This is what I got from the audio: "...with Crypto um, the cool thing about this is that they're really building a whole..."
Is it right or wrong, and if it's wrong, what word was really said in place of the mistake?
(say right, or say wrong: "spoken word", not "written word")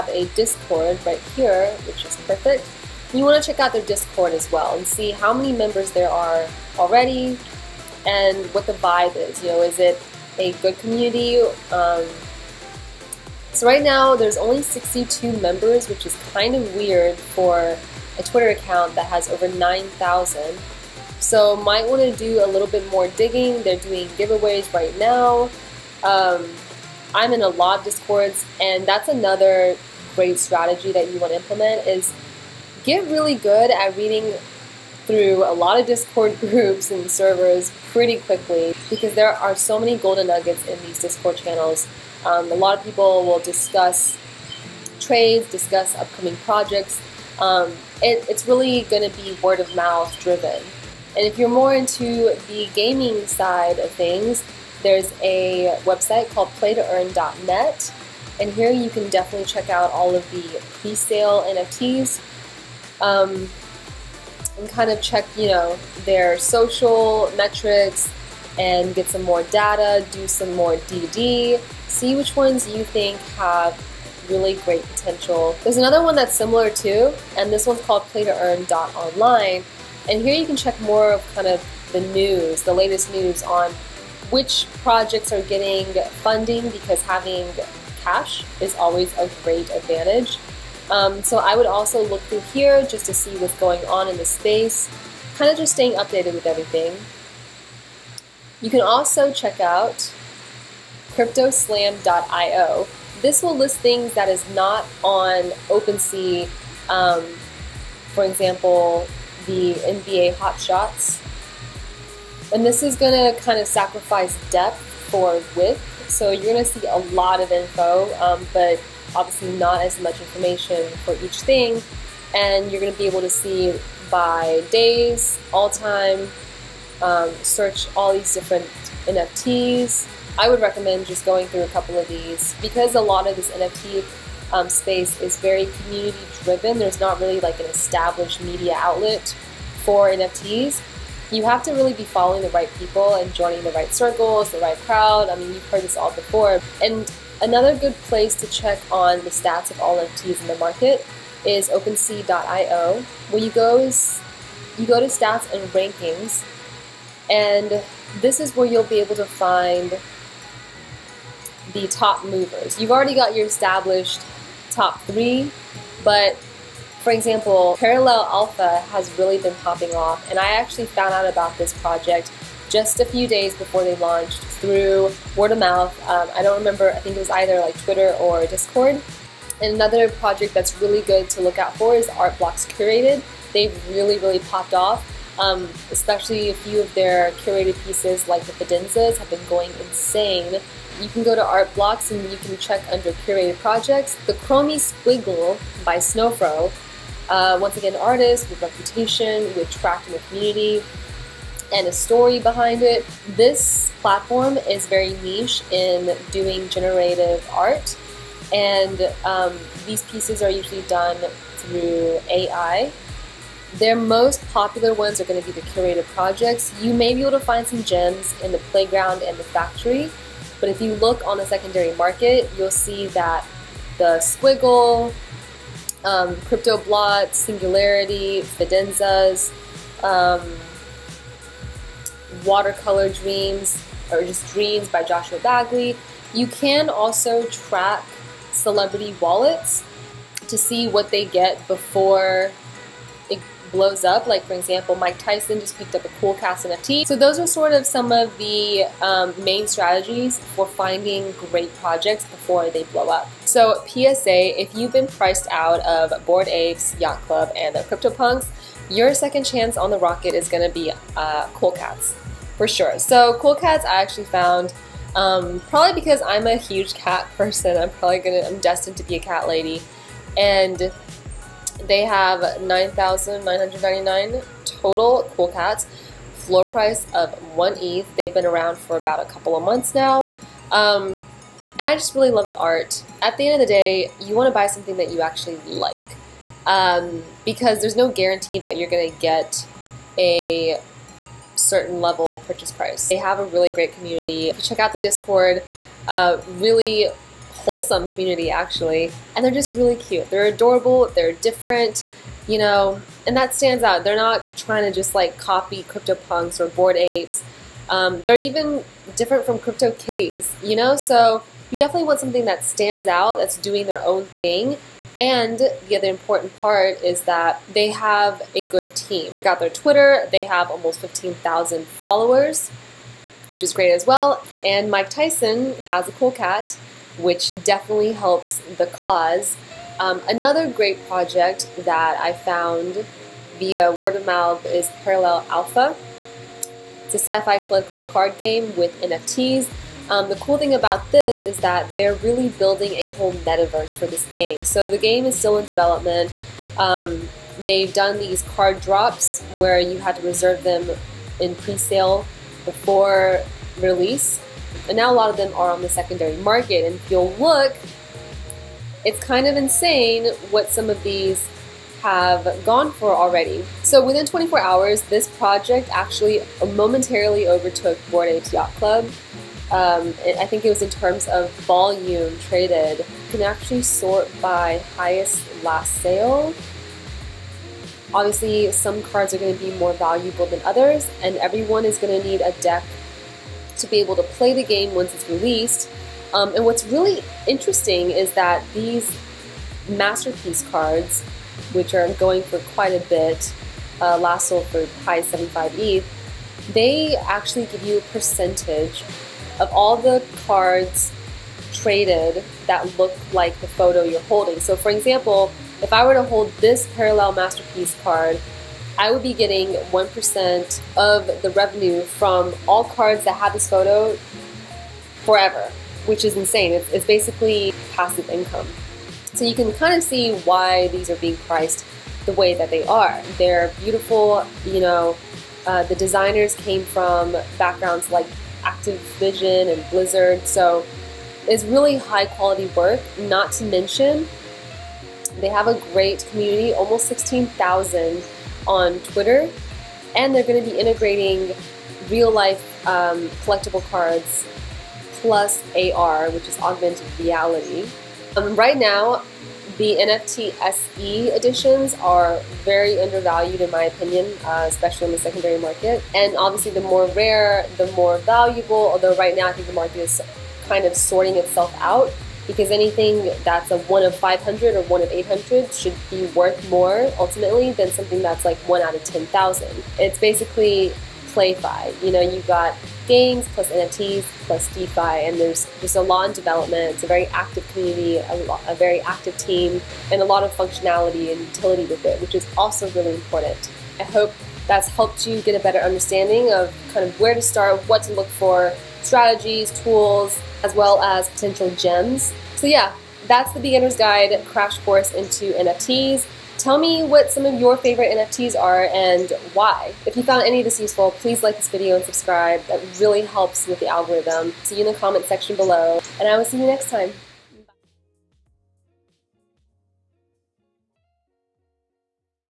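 wrong: "NFTs", not "Crypto".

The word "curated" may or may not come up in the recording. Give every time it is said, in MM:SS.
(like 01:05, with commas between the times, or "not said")
03:02, 03:07, 03:13, 03:35.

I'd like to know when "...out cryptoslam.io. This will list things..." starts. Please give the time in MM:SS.
01:39.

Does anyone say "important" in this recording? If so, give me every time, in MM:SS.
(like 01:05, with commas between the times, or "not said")
05:16, 08:03.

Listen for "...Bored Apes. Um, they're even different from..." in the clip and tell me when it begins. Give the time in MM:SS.
05:06.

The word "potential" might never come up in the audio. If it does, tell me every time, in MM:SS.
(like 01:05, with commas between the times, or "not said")
01:14, 08:11.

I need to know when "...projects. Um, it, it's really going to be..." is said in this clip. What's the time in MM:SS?
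00:46.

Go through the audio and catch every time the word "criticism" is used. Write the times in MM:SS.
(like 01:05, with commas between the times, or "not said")
not said.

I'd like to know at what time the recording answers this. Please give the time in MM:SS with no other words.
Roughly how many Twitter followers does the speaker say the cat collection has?
05:20.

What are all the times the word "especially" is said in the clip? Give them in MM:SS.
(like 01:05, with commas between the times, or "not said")
03:05, 07:34.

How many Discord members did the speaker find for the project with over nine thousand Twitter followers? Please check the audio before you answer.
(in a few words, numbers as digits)
62.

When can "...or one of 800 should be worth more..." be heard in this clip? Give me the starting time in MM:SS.
07:44.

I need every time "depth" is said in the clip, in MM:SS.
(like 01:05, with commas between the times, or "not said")
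01:54.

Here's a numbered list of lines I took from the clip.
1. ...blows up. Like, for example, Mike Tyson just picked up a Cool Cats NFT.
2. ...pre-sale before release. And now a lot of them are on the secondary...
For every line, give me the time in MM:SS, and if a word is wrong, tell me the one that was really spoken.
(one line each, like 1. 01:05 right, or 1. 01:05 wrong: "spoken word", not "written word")
1. 04:03 right
2. 05:51 right.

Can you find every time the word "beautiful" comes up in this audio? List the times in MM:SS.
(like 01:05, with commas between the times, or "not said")
07:03.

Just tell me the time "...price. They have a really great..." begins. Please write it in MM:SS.
04:52.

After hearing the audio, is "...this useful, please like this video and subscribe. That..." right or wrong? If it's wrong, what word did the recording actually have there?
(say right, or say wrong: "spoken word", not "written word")
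right.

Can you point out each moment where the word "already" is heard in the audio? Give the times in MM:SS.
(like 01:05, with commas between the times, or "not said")
00:06, 02:42, 06:03.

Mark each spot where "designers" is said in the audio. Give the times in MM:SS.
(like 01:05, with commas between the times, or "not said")
07:05.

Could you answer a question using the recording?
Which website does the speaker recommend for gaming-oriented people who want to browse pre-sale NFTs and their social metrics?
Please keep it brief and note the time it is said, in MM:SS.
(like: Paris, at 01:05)
playtoearn.net, at 00:56.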